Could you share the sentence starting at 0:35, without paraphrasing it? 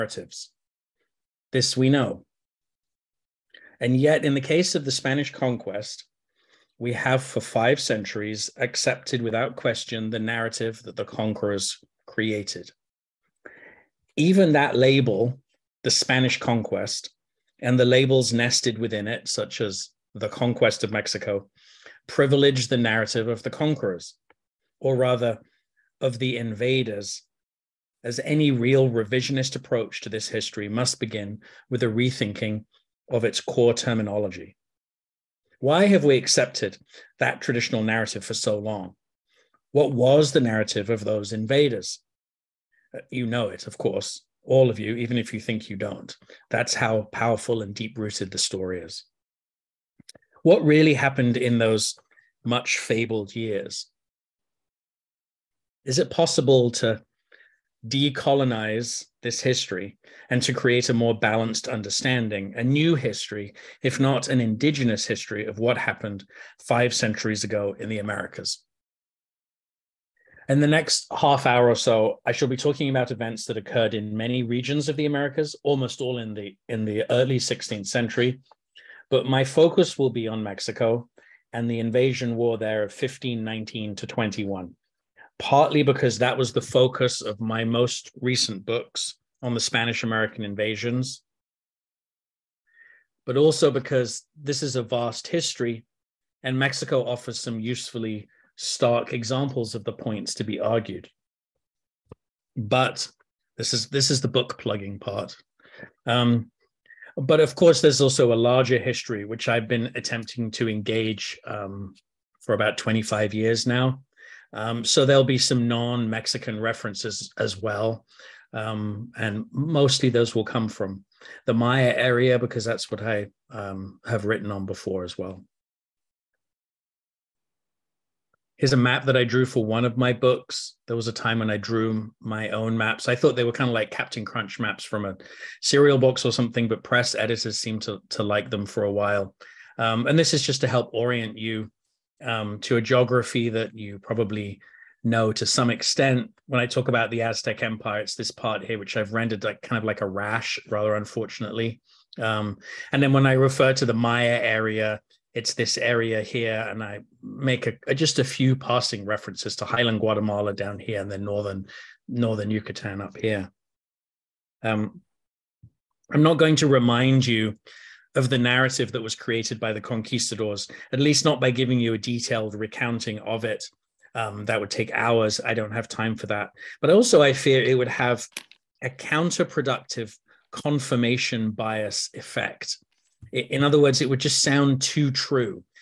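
Why have we accepted that traditional narrative for so long?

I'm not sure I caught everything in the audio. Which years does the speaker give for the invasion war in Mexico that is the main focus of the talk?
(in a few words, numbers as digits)
1519 to 21.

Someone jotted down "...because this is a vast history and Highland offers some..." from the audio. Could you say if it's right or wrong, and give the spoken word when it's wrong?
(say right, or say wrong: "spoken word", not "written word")
wrong: "Mexico", not "Highland".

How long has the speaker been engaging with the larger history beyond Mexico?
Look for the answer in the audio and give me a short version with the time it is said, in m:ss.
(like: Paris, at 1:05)
About 25 years, at 1:52.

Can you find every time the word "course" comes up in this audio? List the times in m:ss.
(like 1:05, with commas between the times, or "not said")
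0:43, 1:47.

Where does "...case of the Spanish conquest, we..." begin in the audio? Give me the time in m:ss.
0:04.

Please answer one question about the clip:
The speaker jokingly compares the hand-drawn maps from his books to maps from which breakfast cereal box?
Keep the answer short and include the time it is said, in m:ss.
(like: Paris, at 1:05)
Captain Crunch, at 2:13.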